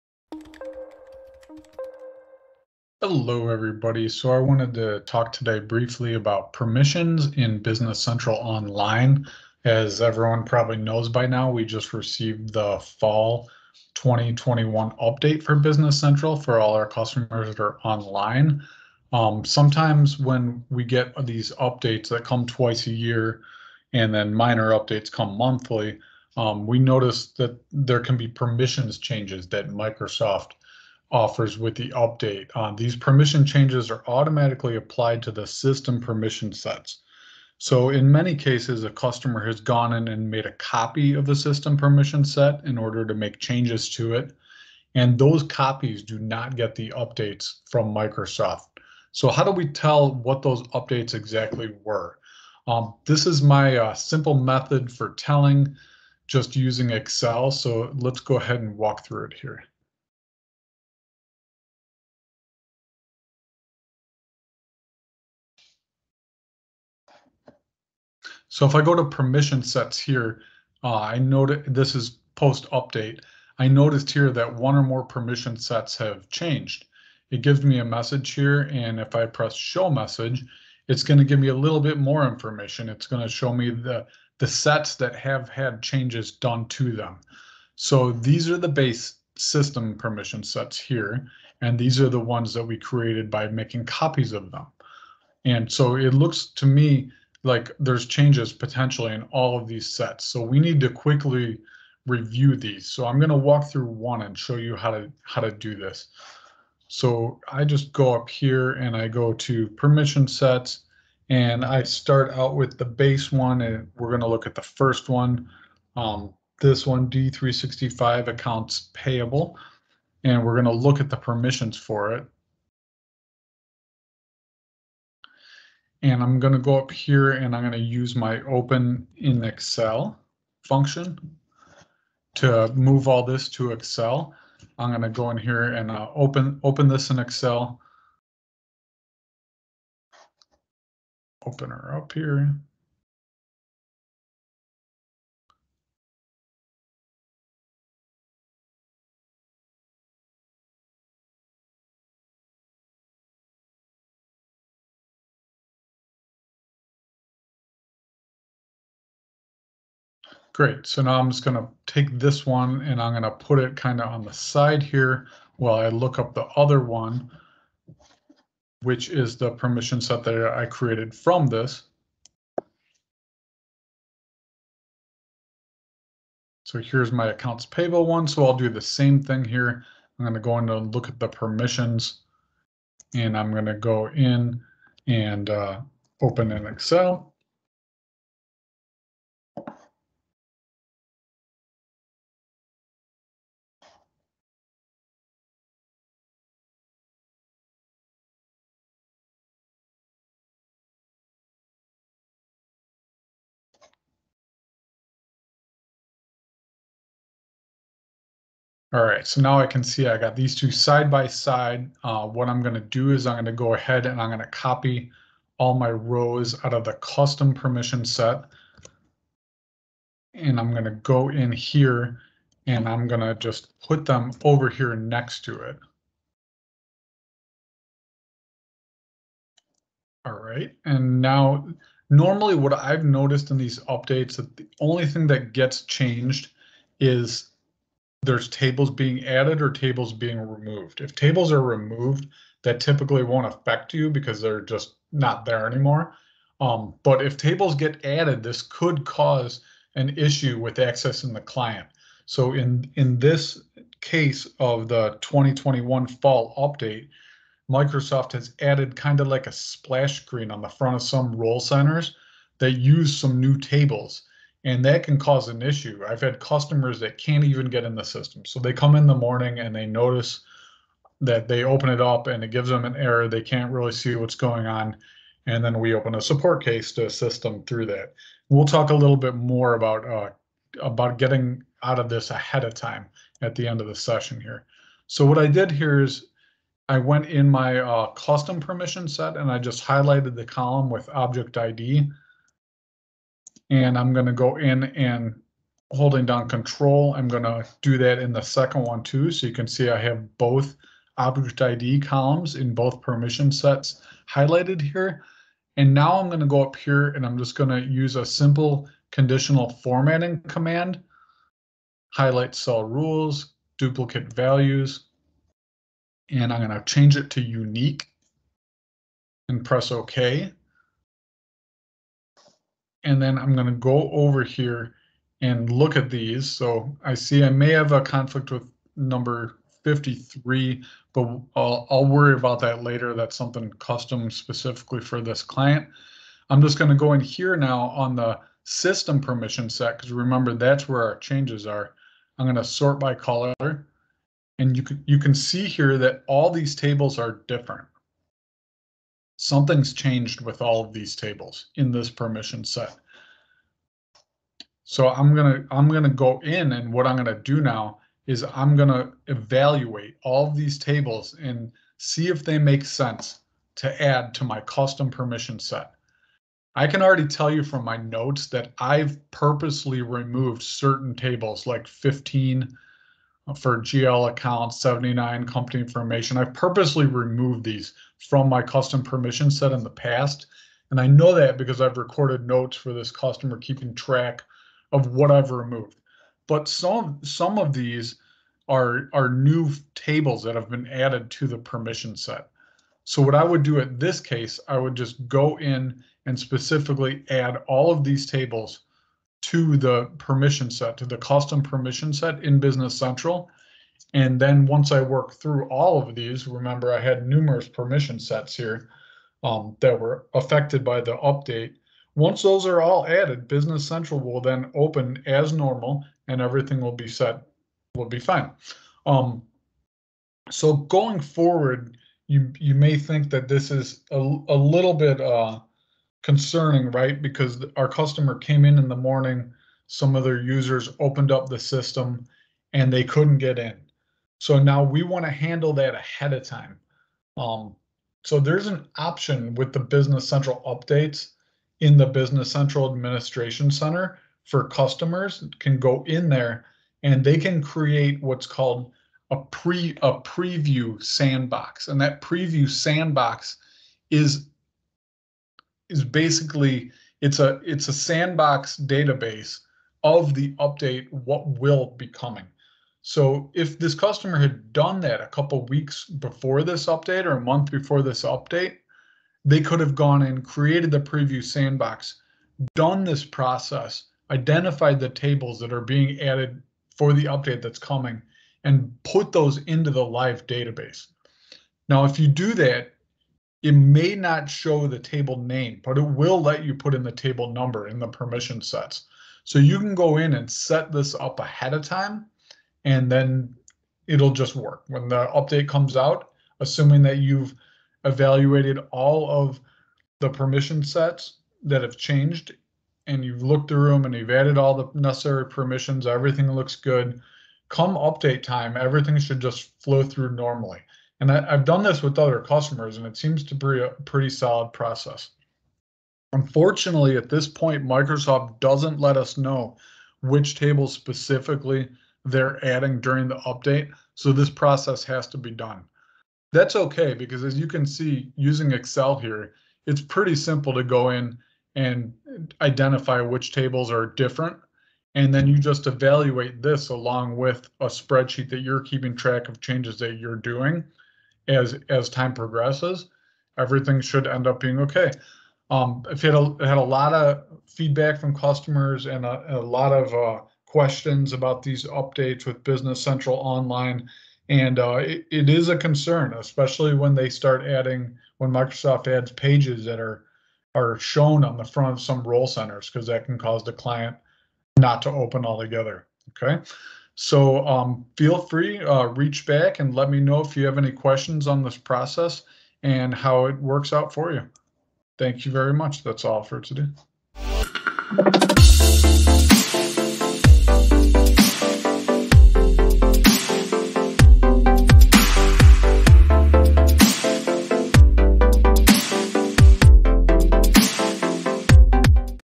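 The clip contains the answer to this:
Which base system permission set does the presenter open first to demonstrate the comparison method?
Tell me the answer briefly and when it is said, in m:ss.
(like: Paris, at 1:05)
D365 accounts payable, at 1:57.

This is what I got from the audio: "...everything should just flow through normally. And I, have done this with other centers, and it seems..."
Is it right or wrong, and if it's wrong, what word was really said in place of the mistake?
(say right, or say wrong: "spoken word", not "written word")
wrong: "customers", not "centers".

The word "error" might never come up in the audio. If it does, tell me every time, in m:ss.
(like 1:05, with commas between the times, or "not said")
4:32.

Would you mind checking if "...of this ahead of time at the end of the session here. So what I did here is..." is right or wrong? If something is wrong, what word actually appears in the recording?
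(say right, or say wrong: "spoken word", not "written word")
right.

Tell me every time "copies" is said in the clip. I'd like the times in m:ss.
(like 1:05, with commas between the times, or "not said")
0:45, 1:33.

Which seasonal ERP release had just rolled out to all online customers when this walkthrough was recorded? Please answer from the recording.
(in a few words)
fall 2021 update.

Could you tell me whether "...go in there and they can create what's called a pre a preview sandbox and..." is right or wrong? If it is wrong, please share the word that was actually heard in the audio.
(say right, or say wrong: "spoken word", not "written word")
right.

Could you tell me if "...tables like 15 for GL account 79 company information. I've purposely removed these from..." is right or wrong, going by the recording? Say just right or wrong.
right.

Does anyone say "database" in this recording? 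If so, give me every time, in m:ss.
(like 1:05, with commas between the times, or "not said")
7:38, 8:00.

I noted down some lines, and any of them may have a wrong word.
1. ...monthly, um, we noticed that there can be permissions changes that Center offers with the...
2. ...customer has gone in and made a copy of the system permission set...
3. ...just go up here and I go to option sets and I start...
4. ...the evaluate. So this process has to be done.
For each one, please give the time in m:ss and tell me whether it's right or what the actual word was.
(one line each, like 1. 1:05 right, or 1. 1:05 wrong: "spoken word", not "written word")
1. 0:25 wrong: "Microsoft", not "Center"
2. 0:38 right
3. 1:47 wrong: "permission", not "option"
4. 8:43 wrong: "update", not "evaluate".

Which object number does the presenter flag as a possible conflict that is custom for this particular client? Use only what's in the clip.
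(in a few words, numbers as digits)
53.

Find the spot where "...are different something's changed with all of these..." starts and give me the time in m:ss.
5:47.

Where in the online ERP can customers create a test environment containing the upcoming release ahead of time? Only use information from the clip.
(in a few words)
Business Central Administration Center.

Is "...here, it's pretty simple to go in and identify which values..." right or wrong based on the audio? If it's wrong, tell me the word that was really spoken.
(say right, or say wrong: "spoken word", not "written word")
wrong: "tables", not "values".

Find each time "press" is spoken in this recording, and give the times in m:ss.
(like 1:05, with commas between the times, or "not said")
1:19, 5:19.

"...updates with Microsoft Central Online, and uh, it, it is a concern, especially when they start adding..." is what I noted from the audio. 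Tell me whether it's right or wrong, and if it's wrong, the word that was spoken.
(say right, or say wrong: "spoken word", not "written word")
wrong: "Business", not "Microsoft".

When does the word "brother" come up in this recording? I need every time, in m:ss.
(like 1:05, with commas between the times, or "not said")
not said.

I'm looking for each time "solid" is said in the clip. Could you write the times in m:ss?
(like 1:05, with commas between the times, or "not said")
8:34.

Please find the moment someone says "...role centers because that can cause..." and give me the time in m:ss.
9:22.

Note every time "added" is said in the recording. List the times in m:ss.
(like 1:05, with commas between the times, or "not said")
3:59, 4:08, 4:18, 6:30, 6:53, 7:56, 8:24.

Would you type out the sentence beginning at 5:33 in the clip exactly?
That's something custom specifically for this client.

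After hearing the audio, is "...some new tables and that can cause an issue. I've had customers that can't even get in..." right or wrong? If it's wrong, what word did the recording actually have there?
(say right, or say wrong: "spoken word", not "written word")
right.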